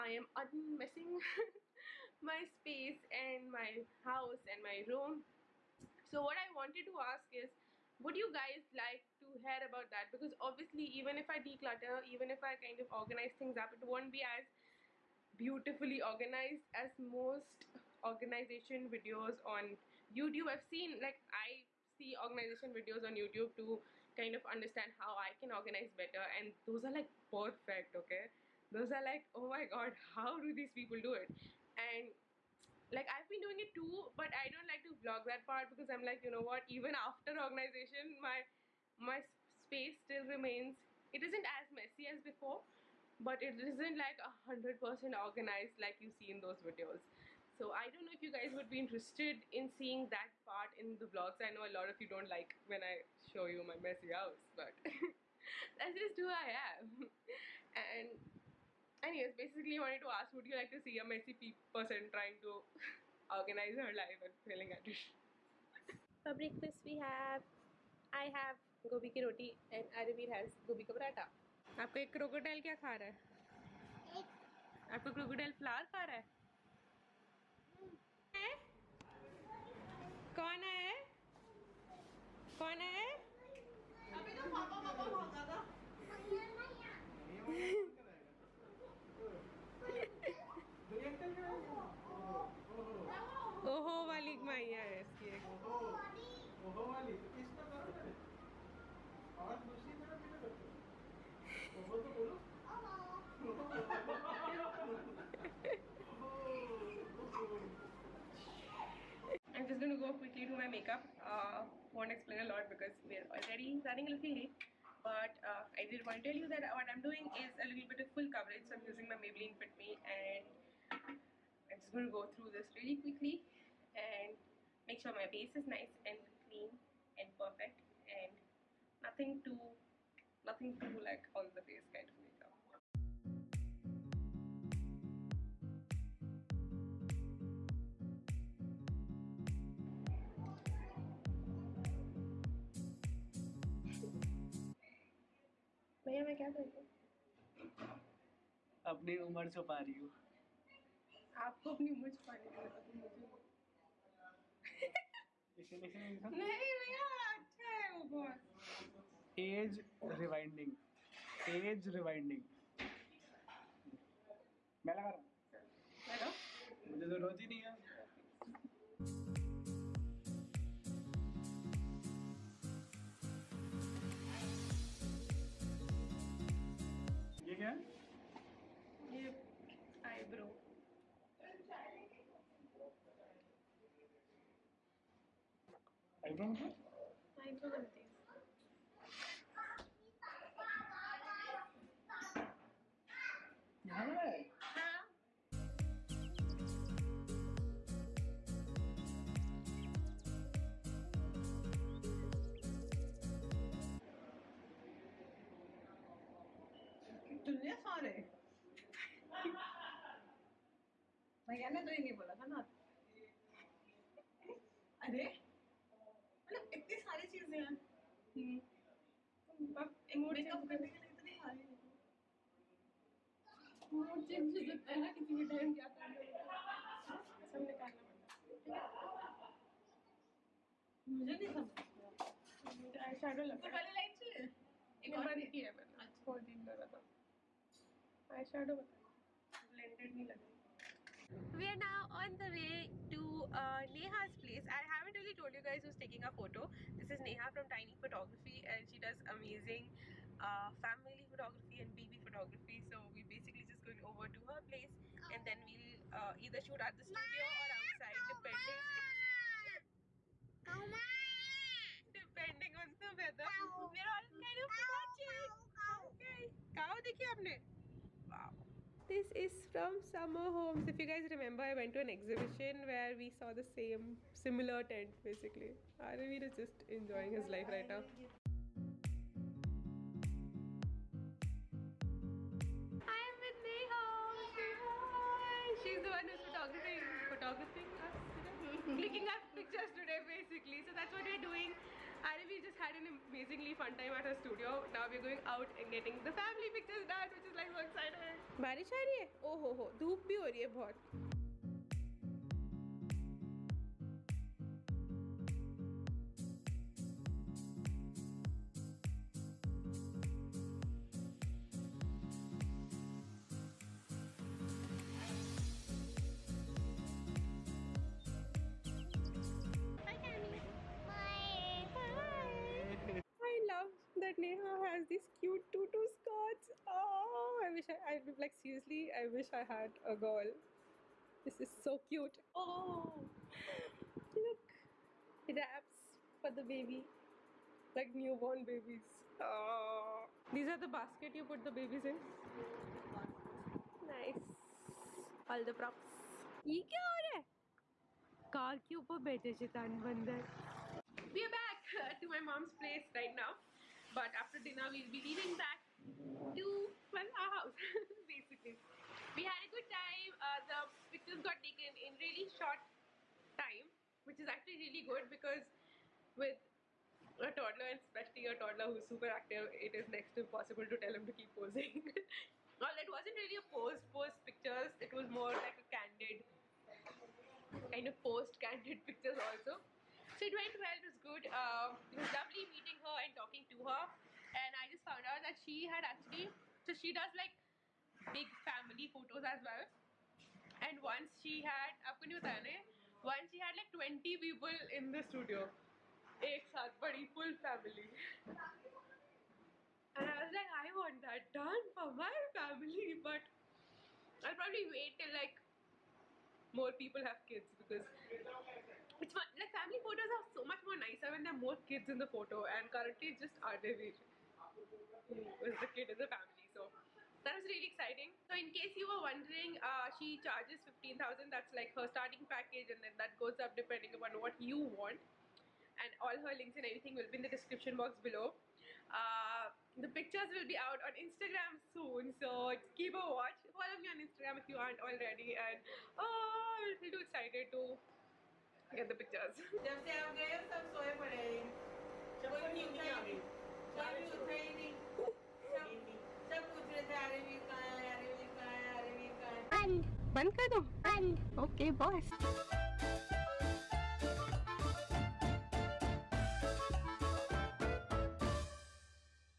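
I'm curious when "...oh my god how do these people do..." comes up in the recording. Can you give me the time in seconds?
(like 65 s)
29 s.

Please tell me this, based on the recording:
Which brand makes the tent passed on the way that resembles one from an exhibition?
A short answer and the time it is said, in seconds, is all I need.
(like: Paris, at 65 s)
Summer Homes, at 270 s.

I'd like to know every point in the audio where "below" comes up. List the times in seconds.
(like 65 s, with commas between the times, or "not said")
428 s.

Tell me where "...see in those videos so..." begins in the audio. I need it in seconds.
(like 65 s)
46 s.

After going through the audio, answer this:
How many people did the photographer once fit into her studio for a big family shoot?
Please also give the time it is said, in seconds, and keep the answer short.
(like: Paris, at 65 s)
20, at 393 s.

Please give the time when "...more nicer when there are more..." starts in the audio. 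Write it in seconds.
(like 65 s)
410 s.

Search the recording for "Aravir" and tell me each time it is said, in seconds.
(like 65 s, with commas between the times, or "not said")
70 s, 275 s, 413 s.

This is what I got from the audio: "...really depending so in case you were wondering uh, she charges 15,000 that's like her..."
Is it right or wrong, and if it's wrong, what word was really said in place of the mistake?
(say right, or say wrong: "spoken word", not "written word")
wrong: "exciting", not "depending".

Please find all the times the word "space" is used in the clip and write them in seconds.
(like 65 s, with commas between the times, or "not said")
2 s, 39 s.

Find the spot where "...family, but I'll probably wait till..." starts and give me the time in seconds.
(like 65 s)
402 s.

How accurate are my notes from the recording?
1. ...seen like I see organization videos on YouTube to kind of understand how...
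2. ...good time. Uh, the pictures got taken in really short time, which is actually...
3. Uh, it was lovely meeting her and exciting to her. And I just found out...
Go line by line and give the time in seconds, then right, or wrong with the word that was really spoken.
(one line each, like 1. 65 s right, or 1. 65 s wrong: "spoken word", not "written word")
1. 20 s right
2. 359 s right
3. 381 s wrong: "talking", not "exciting".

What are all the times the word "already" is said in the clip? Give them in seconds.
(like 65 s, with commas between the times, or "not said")
113 s, 435 s.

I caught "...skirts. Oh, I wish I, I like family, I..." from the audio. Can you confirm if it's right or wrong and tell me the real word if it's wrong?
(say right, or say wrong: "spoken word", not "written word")
wrong: "seriously", not "family".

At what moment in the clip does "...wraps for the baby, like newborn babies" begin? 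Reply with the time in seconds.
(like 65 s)
335 s.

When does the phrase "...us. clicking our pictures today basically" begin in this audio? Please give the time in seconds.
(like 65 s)
288 s.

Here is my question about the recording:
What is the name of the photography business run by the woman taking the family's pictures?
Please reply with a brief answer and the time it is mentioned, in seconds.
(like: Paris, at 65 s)
Tiny Photography, at 247 s.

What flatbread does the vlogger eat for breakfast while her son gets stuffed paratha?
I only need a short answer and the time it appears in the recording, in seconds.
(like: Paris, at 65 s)
gobi ki roti, at 68 s.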